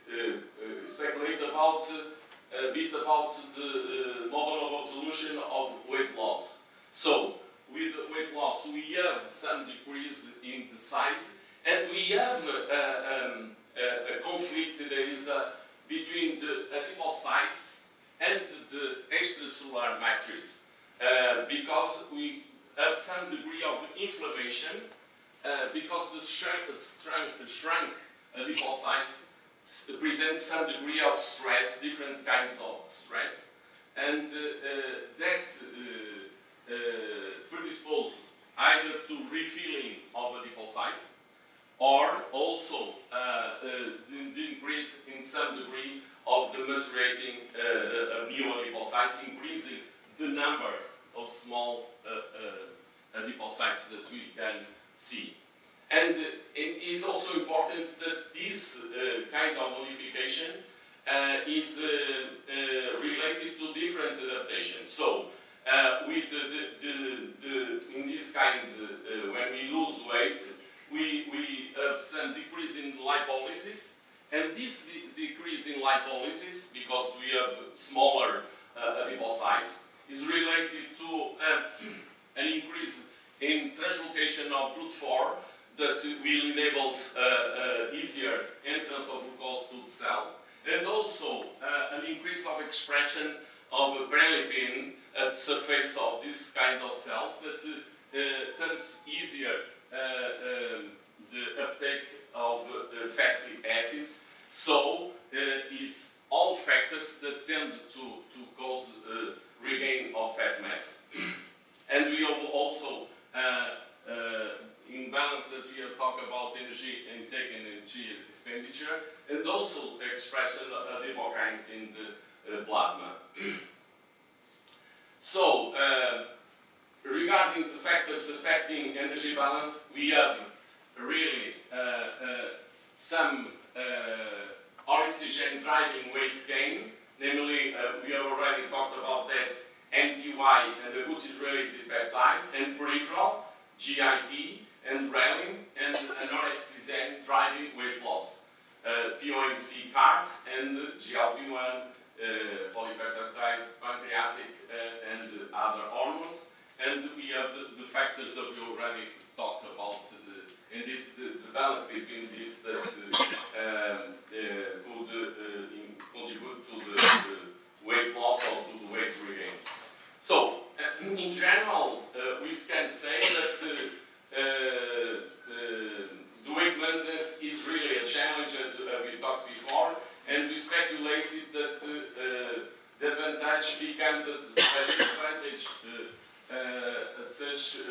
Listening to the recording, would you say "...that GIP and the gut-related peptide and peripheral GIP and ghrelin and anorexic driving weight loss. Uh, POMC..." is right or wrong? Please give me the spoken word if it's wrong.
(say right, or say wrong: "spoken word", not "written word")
wrong: "NPY", not "GIP".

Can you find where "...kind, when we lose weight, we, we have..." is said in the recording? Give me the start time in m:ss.
1:08.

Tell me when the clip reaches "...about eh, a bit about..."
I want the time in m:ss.
0:01.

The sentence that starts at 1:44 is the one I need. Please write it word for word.
So it's all factors that tend to, to cause uh, regain of fat mass.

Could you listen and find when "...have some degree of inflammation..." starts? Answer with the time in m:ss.
0:22.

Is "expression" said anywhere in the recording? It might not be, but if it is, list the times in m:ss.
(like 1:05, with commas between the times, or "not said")
1:32, 2:00.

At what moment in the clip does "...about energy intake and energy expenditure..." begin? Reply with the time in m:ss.
1:56.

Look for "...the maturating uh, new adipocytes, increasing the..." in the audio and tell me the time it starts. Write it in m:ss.
0:46.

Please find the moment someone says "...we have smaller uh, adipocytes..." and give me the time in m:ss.
1:17.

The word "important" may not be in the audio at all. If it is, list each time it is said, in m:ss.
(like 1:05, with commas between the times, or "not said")
0:57.